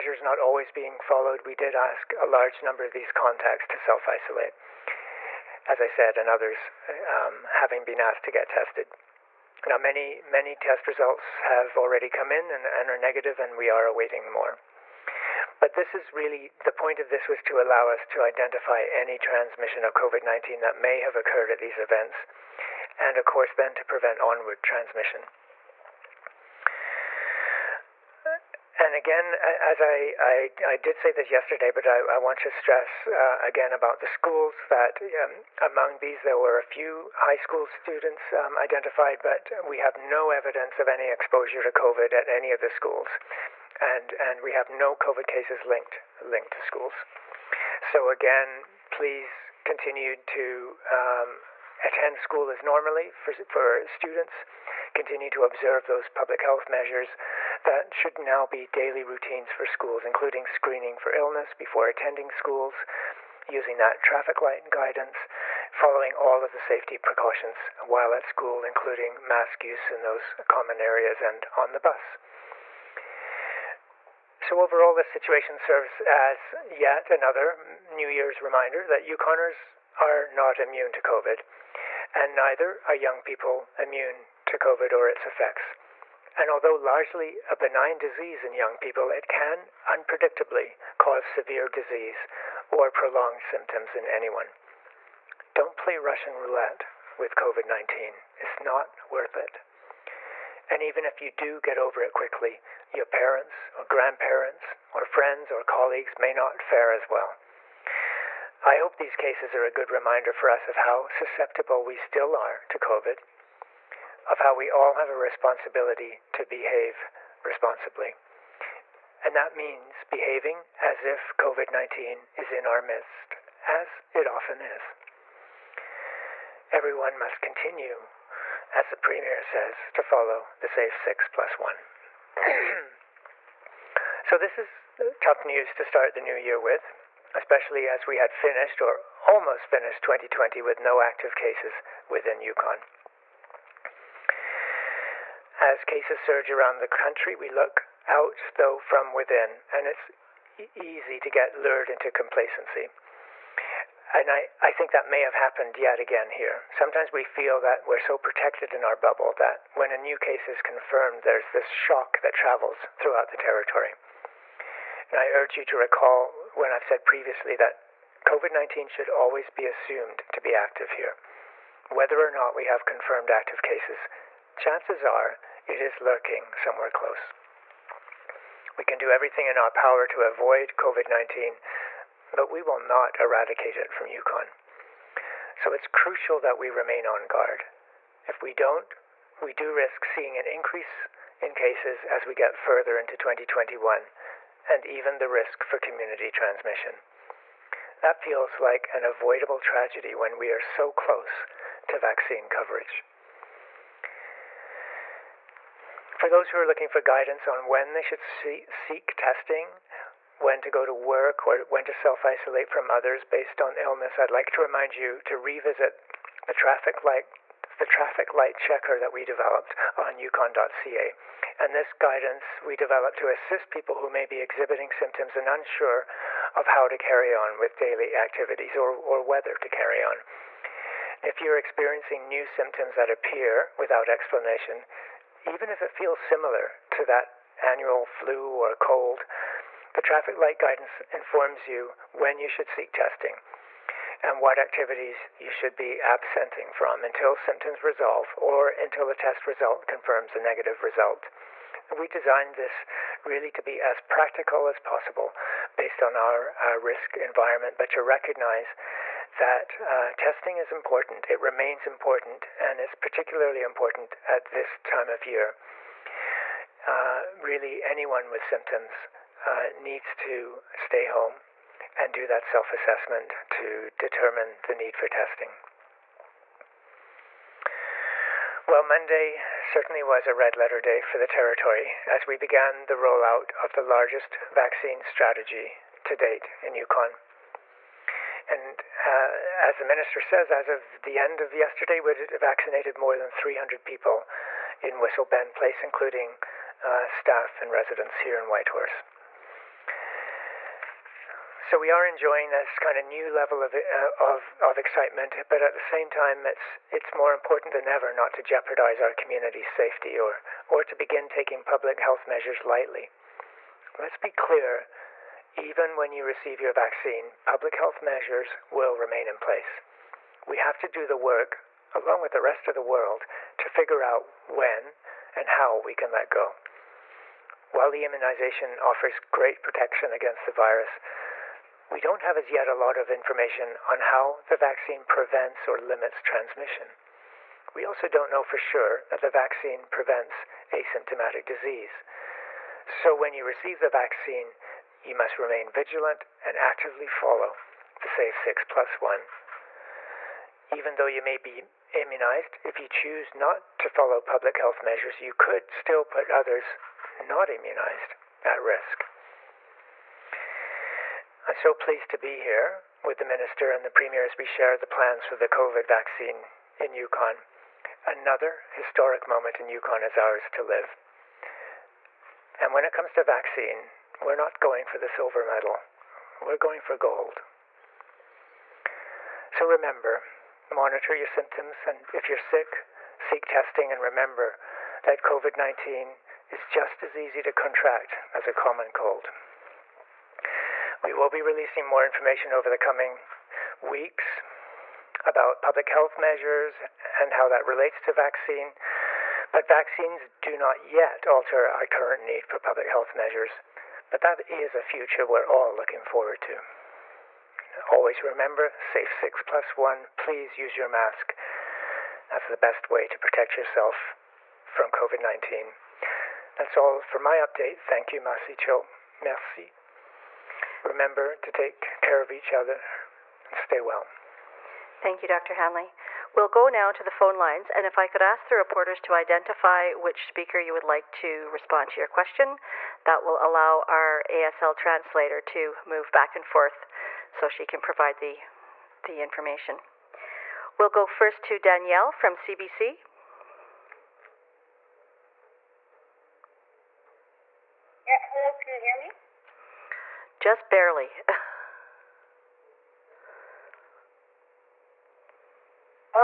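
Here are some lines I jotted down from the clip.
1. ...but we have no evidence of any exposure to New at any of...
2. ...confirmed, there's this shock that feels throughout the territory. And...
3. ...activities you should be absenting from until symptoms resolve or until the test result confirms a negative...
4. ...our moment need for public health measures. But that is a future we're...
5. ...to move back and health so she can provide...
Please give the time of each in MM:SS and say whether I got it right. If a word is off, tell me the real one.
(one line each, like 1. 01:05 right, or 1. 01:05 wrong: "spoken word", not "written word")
1. 00:39 wrong: "COVID", not "New"
2. 02:40 wrong: "travels", not "feels"
3. 04:04 right
4. 06:41 wrong: "current", not "moment"
5. 07:15 wrong: "forth", not "health".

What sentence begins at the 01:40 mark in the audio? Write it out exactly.
And even if you do get over it quickly, your parents or grandparents or friends or colleagues may not fare as well.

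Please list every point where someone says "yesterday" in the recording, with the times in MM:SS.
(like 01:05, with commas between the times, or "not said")
00:31, 04:51.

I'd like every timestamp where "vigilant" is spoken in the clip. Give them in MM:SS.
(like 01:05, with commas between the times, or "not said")
05:45.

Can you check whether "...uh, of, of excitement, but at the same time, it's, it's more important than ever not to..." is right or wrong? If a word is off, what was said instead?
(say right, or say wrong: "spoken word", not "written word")
right.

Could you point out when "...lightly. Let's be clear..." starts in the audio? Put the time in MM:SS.
05:12.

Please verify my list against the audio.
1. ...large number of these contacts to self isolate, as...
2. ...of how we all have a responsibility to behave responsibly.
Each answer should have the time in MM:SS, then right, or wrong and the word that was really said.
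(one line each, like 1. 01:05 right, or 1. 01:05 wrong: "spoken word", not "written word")
1. 00:02 right
2. 01:54 right.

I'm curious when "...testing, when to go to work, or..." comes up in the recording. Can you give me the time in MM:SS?
03:29.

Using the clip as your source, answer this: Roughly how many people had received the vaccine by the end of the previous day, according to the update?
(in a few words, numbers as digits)
more than 300.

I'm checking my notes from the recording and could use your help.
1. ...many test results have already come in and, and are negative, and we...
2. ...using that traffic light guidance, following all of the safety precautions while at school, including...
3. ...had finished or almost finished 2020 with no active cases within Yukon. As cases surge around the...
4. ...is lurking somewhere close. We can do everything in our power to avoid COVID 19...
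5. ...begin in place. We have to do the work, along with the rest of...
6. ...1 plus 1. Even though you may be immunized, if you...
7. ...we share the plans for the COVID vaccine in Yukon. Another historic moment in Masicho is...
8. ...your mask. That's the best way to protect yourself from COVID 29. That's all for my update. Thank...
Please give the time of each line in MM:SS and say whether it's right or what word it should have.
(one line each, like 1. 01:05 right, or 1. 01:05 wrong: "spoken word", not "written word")
1. 00:10 right
2. 01:03 right
3. 02:18 right
4. 02:55 right
5. 05:18 wrong: "remain", not "begin"
6. 05:48 wrong: "6", not "1"
7. 06:04 wrong: "Yukon", not "Masicho"
8. 06:50 wrong: "19", not "29".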